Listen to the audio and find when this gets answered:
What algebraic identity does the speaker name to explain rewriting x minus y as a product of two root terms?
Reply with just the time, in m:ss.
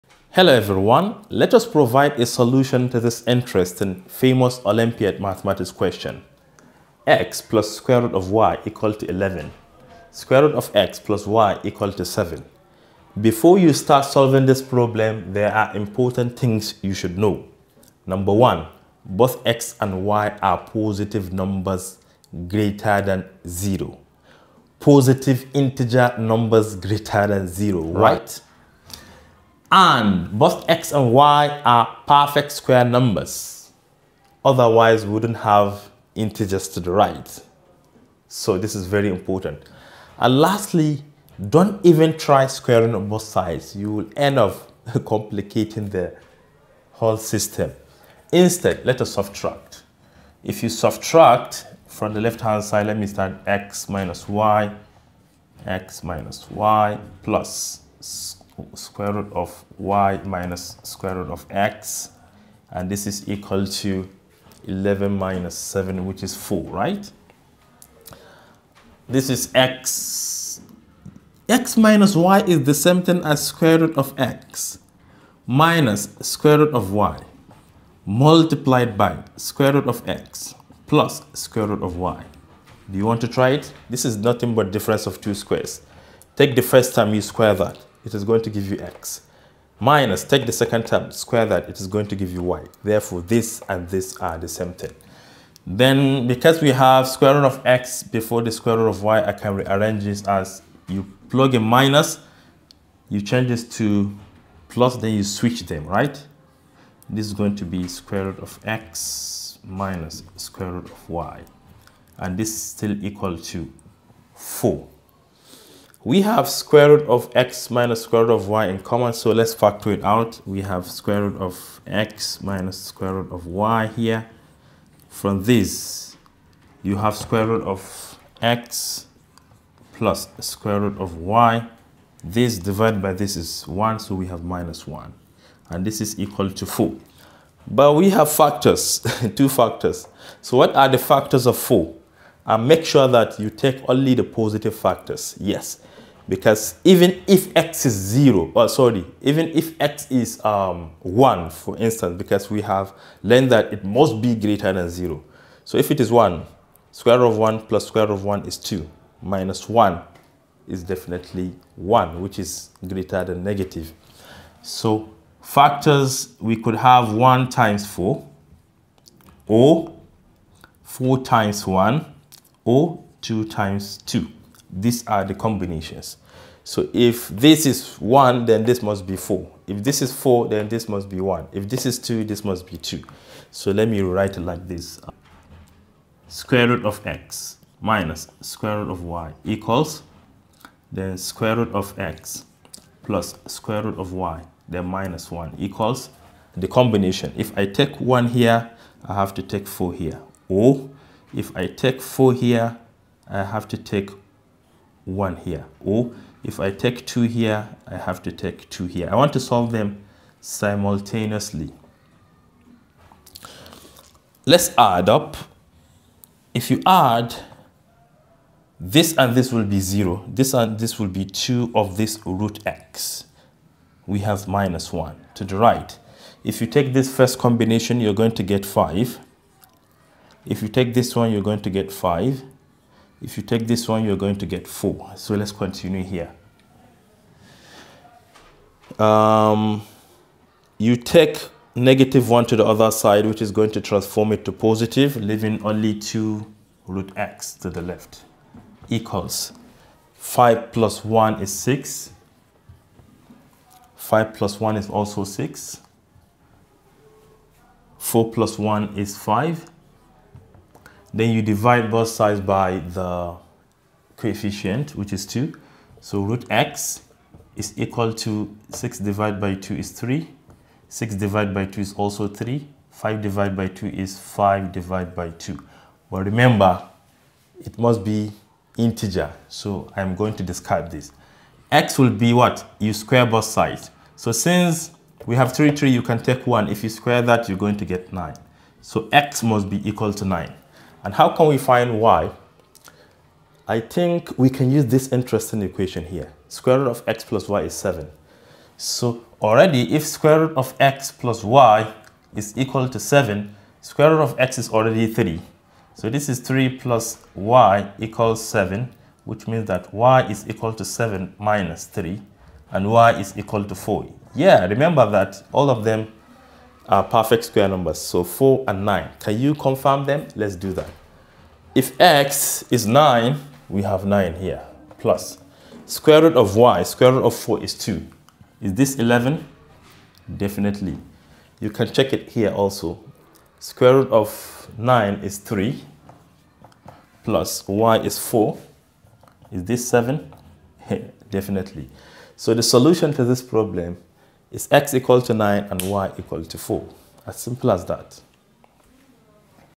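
1:24.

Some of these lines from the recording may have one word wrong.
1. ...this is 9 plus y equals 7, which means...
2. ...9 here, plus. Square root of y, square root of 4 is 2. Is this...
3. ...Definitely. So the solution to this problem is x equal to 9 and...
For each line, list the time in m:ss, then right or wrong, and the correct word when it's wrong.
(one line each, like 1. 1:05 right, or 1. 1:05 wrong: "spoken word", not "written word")
1. 5:06 wrong: "3", not "9"
2. 5:24 right
3. 5:41 right.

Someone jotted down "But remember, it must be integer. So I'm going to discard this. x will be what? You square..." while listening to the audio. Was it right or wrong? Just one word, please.
right.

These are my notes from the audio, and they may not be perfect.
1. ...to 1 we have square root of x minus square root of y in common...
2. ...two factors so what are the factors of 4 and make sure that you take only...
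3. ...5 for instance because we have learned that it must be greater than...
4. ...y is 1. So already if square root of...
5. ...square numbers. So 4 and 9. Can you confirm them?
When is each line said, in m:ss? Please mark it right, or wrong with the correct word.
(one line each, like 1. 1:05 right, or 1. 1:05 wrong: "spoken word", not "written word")
1. 1:53 wrong: "4", not "1"
2. 2:19 right
3. 2:31 wrong: "1", not "5"
4. 4:57 wrong: "7", not "1"
5. 5:17 right.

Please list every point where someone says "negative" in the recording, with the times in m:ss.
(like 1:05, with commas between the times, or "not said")
2:43, 4:01.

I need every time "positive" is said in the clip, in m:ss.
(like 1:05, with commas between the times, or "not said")
0:20, 0:24, 2:24, 4:04.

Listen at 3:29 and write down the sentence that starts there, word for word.
I want to solve them simultaneously.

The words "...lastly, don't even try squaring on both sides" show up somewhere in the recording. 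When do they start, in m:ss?
0:40.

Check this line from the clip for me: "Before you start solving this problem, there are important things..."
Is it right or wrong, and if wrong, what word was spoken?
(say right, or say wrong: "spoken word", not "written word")
right.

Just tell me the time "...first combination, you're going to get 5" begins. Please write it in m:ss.
3:47.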